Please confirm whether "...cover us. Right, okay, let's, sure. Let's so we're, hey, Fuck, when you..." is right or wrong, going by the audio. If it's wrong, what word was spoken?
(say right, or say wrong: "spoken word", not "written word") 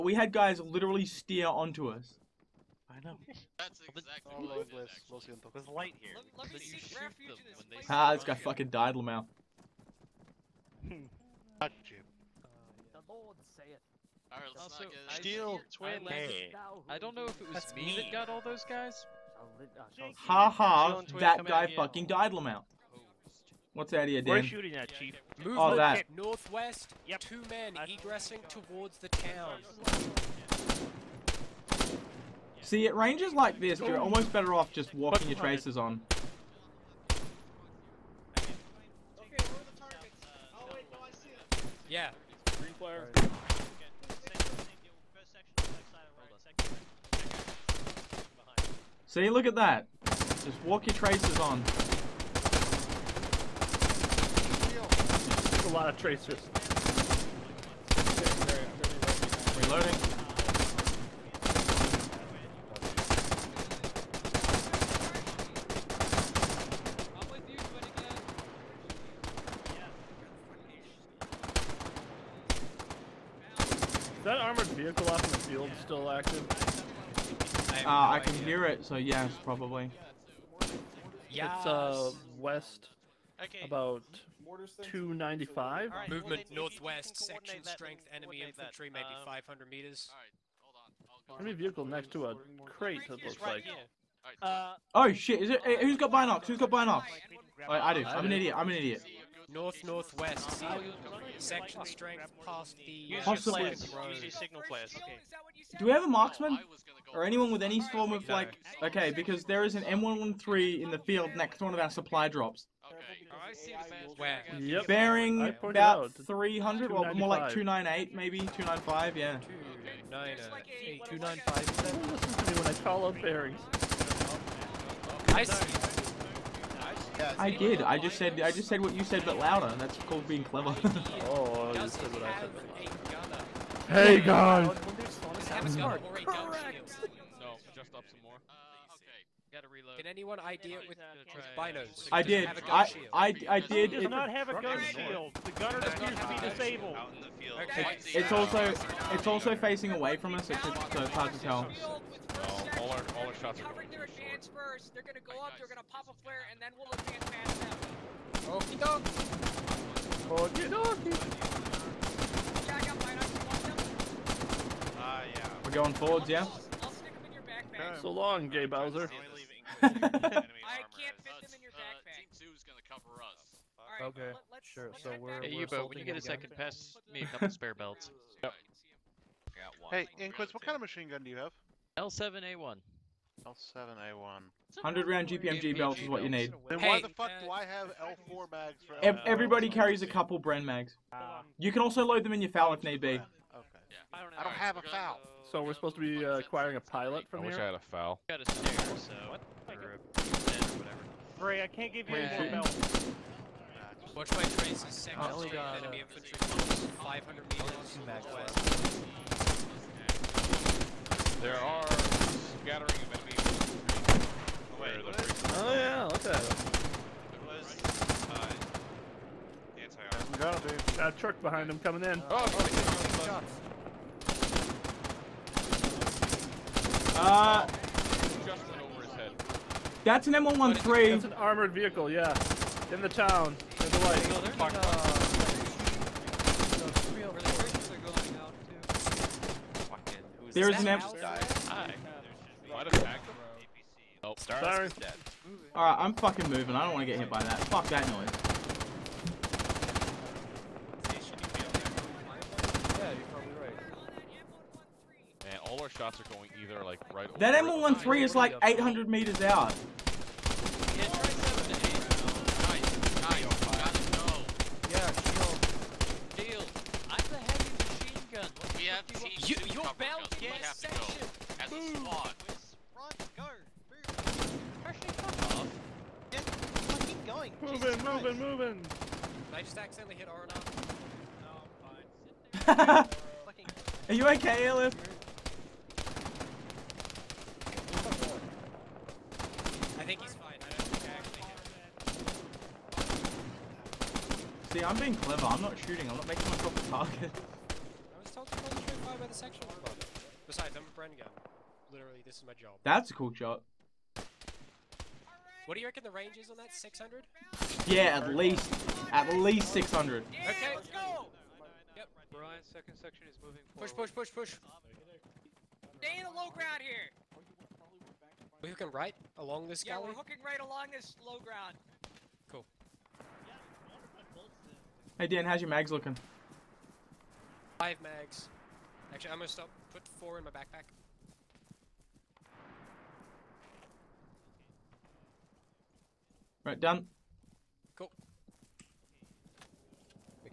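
wrong: "Yubo", not "Fuck".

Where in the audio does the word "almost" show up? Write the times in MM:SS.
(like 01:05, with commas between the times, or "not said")
00:33.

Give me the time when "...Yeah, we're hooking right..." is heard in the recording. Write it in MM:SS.
05:19.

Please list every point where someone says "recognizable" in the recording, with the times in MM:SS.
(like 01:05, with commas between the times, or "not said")
not said.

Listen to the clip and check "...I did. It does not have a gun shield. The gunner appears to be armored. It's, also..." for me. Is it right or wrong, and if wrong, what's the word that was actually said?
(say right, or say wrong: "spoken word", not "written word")
wrong: "disabled", not "armored".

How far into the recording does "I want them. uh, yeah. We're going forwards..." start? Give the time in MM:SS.
02:42.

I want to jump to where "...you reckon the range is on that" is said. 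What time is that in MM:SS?
05:05.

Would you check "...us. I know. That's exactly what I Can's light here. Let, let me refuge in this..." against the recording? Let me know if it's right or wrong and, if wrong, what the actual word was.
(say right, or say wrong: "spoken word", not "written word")
wrong: "There", not "Can".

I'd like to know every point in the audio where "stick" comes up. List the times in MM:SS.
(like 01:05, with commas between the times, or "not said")
02:46.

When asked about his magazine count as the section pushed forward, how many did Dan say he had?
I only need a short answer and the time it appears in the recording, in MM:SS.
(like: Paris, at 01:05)
Five, at 05:27.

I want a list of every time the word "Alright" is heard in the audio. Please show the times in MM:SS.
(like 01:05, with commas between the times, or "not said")
00:14, 04:05.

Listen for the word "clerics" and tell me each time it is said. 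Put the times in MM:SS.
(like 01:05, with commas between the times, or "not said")
not said.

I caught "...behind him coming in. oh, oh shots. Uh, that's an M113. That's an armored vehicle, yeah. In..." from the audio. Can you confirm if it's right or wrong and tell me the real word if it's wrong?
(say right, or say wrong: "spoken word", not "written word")
right.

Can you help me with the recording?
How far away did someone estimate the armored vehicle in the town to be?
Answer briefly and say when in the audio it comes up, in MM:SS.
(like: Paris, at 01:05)
800 meters, at 04:18.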